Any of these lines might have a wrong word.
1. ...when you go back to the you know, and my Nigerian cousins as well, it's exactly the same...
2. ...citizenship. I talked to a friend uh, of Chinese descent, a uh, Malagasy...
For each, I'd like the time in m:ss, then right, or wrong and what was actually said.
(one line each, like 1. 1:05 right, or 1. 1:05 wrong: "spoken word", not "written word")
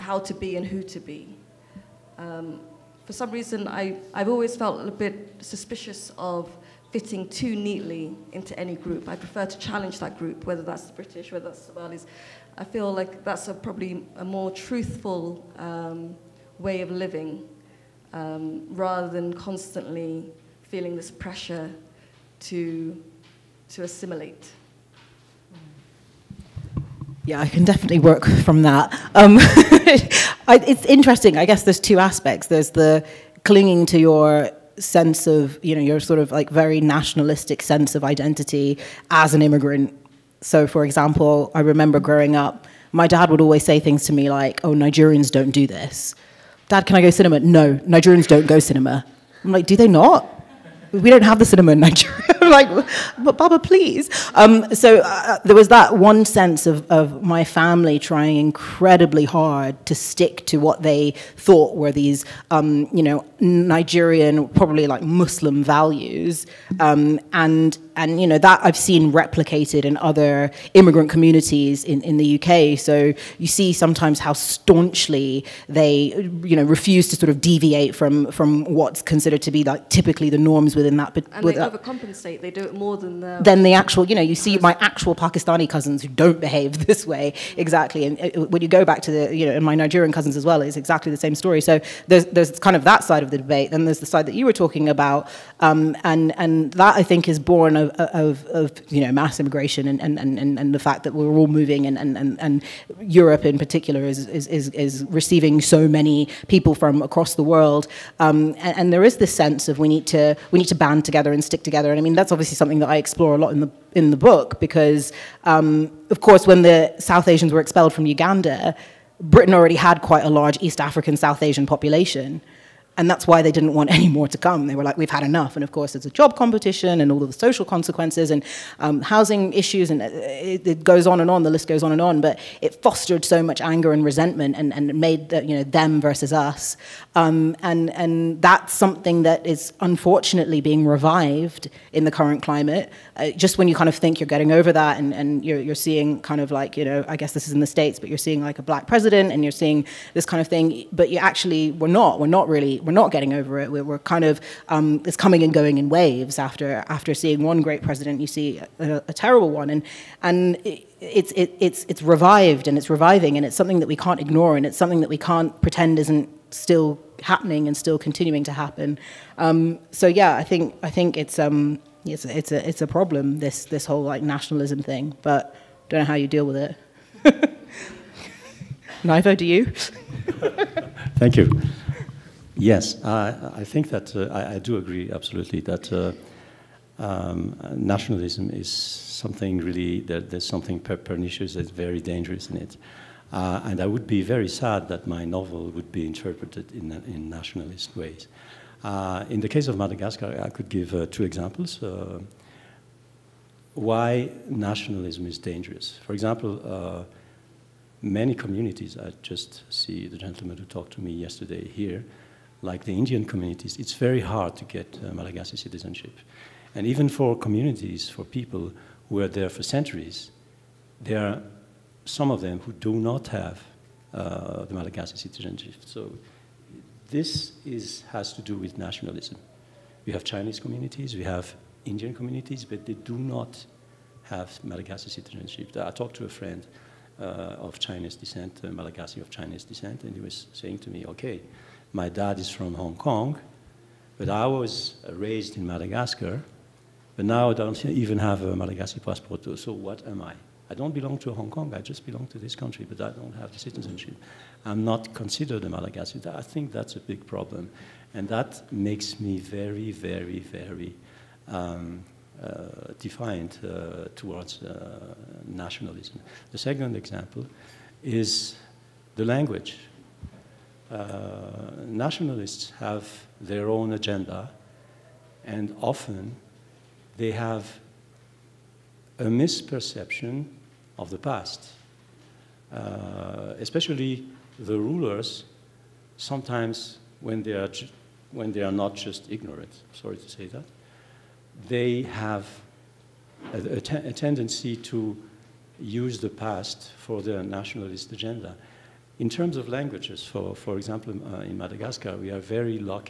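1. 1:28 right
2. 3:55 right.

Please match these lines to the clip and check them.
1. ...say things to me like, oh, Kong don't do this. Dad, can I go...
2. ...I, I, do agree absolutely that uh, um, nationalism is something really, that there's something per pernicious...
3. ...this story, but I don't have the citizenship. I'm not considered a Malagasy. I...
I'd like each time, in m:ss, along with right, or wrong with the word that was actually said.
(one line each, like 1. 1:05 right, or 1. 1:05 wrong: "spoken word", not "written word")
1. 0:43 wrong: "Nigerians", not "Kong"
2. 3:04 right
3. 4:12 wrong: "country", not "story".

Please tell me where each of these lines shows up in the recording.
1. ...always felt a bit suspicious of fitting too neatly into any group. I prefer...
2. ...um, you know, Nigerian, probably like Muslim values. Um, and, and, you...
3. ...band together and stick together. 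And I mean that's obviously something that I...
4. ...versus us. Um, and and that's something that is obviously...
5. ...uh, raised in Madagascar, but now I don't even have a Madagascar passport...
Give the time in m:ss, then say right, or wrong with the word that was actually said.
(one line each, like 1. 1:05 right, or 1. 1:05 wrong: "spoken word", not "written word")
1. 0:04 right
2. 1:02 right
3. 1:50 right
4. 2:16 wrong: "unfortunately", not "obviously"
5. 4:05 right.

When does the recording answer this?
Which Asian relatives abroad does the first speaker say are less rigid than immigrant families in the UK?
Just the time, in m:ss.
1:25.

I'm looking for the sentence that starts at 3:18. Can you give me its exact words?
Uh, in the case of Madagascar, I could give uh, two examples uh, why nationalism is dangerous.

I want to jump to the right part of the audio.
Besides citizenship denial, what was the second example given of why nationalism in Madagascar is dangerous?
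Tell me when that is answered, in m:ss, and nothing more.
4:26.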